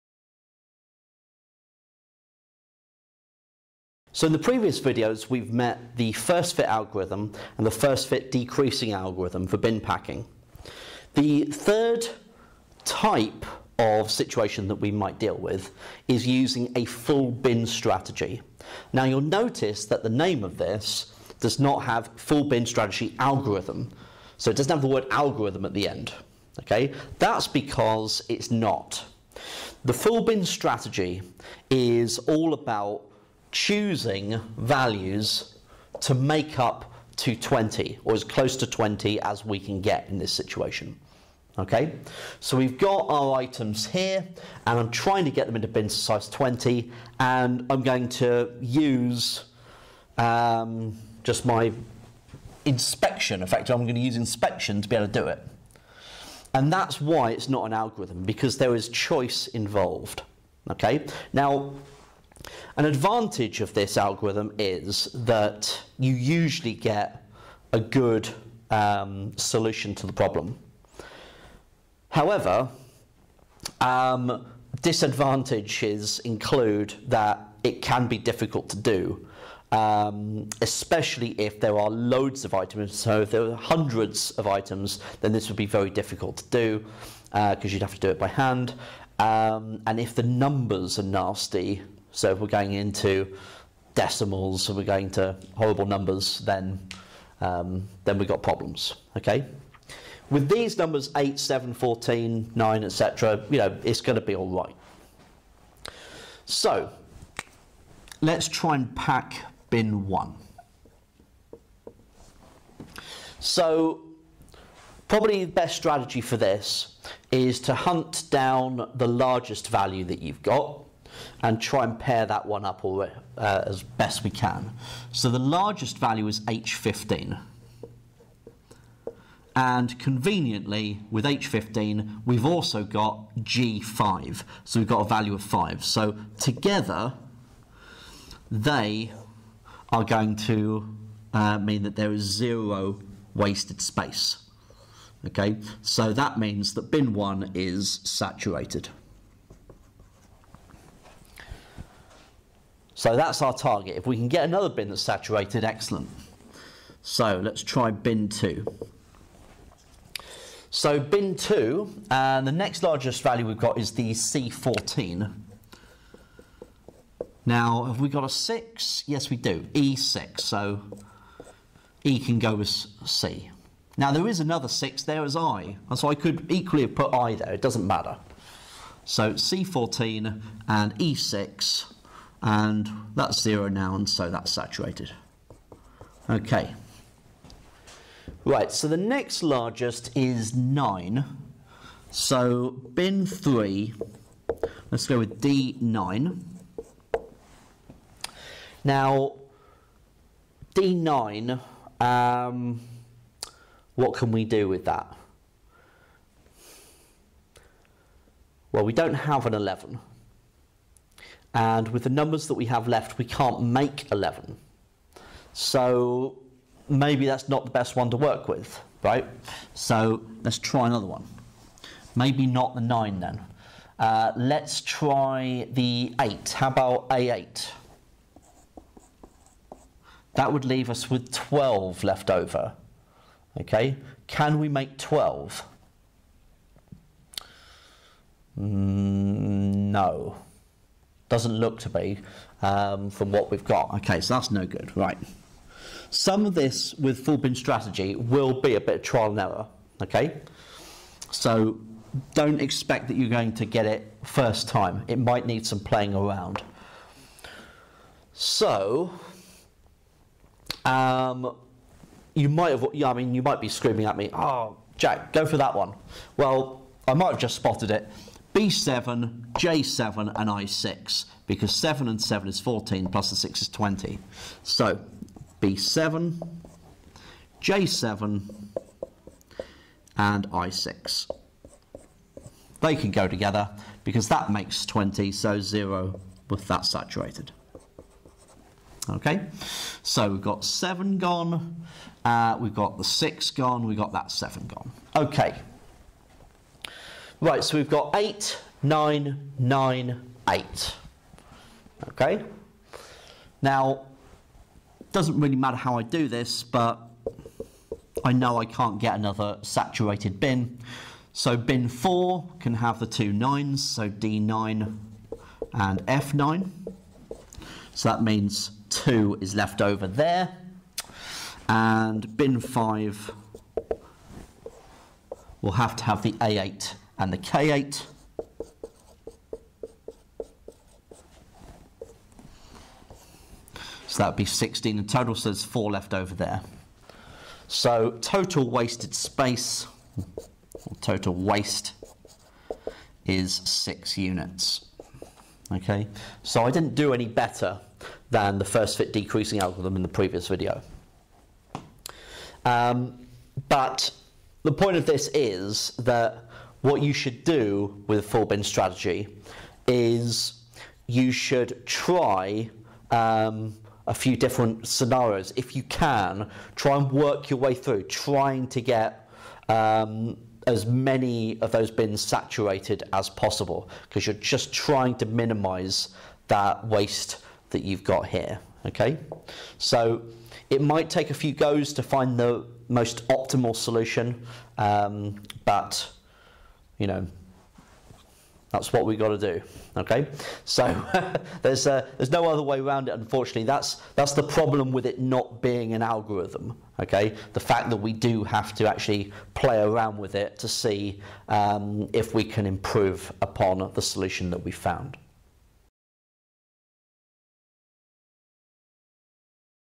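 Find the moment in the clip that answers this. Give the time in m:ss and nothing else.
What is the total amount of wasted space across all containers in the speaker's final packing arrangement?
5:43.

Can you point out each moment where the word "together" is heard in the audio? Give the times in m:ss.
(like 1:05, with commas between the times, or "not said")
2:16, 4:43.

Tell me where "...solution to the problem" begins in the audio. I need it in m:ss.
1:09.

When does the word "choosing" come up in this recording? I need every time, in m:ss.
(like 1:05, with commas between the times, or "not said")
0:33.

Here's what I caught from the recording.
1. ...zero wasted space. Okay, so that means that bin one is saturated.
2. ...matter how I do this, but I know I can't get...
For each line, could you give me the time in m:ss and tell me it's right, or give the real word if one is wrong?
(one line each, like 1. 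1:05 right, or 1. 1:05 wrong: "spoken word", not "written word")
1. 2:22 right
2. 5:05 right.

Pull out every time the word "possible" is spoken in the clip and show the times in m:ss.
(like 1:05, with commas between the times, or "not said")
6:13.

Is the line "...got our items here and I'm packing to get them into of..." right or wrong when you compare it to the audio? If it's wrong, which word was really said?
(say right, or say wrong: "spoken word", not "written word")
wrong: "trying", not "packing".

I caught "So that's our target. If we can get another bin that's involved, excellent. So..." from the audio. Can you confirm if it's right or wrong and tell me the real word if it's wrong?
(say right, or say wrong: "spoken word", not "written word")
wrong: "saturated", not "involved".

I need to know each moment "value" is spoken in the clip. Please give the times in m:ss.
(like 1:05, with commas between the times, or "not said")
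0:34, 1:59, 2:05, 2:15, 2:43.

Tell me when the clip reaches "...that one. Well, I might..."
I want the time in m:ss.
4:25.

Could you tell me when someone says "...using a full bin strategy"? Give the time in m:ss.
0:16.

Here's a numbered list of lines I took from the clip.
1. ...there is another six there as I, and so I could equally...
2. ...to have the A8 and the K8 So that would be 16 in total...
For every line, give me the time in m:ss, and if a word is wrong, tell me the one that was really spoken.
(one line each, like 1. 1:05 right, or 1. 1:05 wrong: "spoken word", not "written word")
1. 2:54 right
2. 5:25 right.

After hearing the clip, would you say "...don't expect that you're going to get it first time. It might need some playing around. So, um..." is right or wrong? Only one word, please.
right.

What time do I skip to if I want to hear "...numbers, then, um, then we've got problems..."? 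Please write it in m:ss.
1:35.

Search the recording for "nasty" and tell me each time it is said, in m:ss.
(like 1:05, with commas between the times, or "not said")
1:31.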